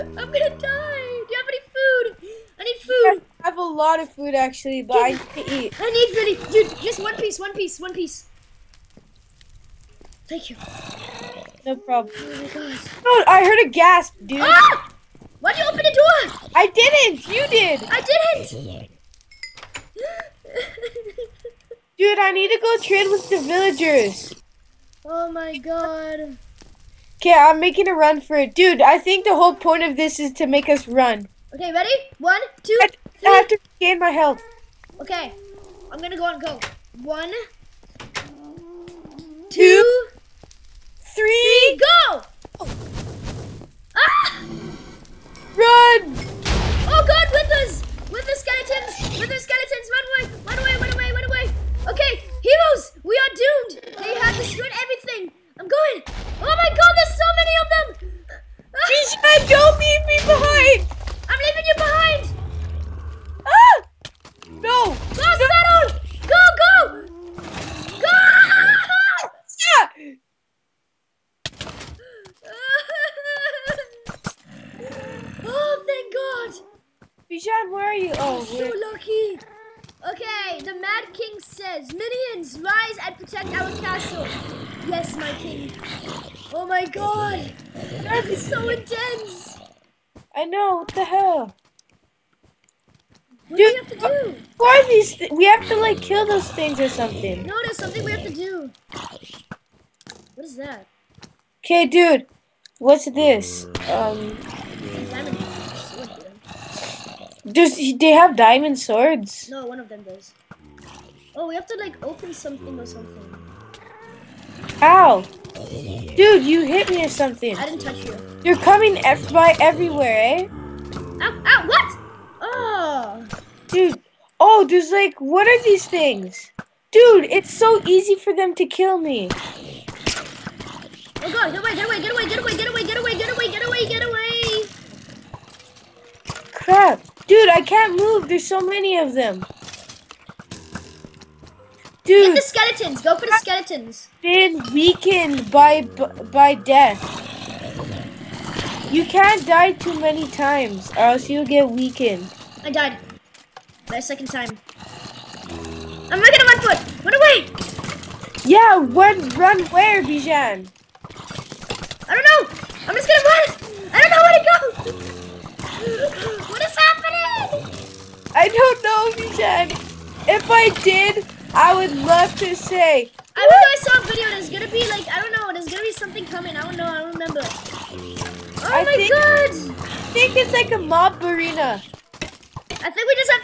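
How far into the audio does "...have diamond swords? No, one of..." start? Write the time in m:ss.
1:48.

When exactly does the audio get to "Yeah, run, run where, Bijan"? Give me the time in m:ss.
2:38.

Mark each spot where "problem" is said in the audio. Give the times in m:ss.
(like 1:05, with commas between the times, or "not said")
0:11.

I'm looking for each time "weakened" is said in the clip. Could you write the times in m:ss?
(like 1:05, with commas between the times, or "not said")
2:24, 2:31.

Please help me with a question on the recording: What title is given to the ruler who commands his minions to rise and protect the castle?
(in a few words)
the Mad King.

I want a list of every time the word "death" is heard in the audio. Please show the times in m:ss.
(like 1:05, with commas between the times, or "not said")
2:26.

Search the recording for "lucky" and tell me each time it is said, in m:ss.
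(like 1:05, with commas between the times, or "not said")
1:18.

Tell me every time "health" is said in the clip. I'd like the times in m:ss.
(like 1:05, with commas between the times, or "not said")
0:34.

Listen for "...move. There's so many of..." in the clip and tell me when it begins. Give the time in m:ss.
2:17.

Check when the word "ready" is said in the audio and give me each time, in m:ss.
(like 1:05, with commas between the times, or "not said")
0:31.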